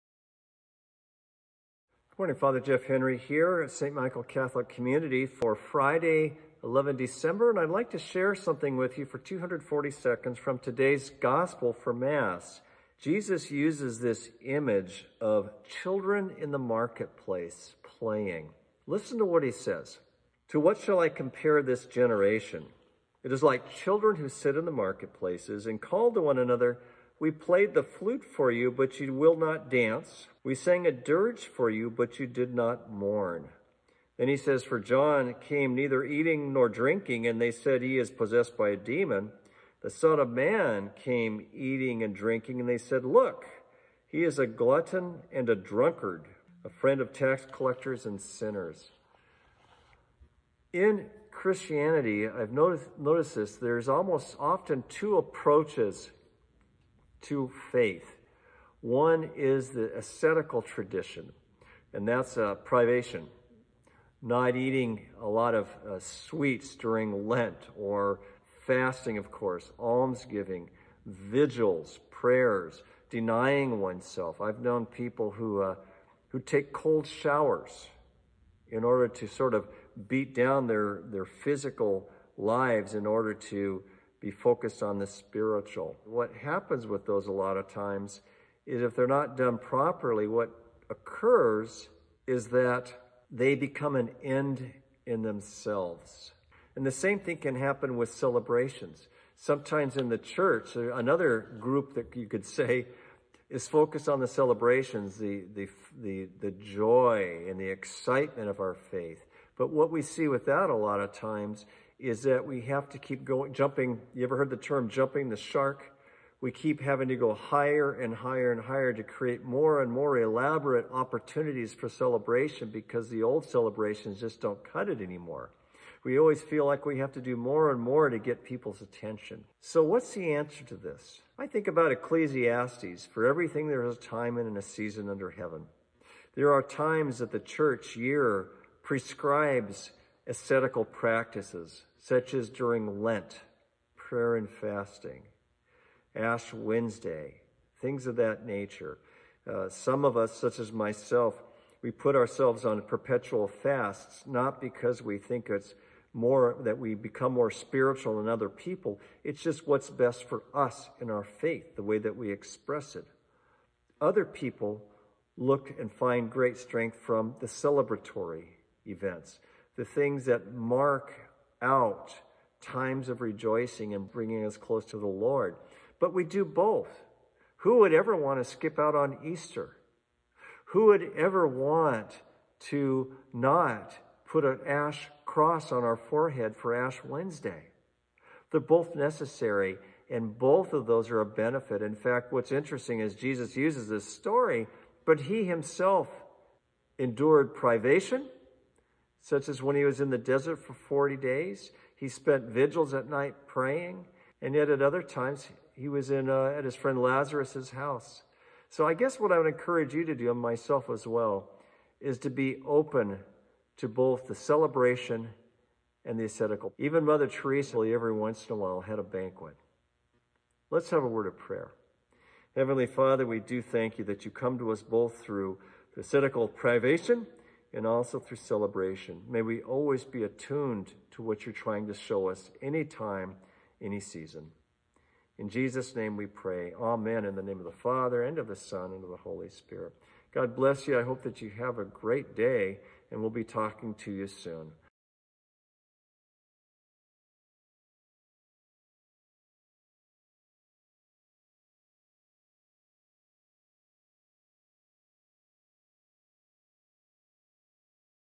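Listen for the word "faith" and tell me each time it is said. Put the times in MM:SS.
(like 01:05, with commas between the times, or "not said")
00:57, 01:48, 02:41.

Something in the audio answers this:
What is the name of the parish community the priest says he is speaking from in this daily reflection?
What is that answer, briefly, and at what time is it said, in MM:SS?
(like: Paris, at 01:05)
St. Michael Catholic Community, at 00:03.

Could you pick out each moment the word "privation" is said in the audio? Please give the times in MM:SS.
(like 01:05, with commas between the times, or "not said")
01:02, 03:17, 03:46.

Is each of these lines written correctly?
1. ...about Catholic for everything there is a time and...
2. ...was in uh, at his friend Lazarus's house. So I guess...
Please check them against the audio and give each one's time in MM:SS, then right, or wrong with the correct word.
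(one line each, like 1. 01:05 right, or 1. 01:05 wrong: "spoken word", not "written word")
1. 02:11 wrong: "Ecclesiastes", not "Catholic"
2. 03:25 right.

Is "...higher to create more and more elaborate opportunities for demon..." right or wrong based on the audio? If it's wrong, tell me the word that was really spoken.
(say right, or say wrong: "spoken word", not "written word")
wrong: "celebration", not "demon".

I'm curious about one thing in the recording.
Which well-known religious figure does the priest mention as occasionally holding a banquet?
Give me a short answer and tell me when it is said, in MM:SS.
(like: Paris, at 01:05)
Mother Teresa, at 03:37.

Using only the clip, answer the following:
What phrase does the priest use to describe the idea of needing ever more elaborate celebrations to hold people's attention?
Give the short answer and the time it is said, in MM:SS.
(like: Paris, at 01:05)
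jumping the shark, at 01:54.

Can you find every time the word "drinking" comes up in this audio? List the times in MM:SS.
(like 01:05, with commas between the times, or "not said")
00:36, 00:42.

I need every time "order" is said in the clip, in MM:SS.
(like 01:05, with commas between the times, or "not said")
01:18, 01:23.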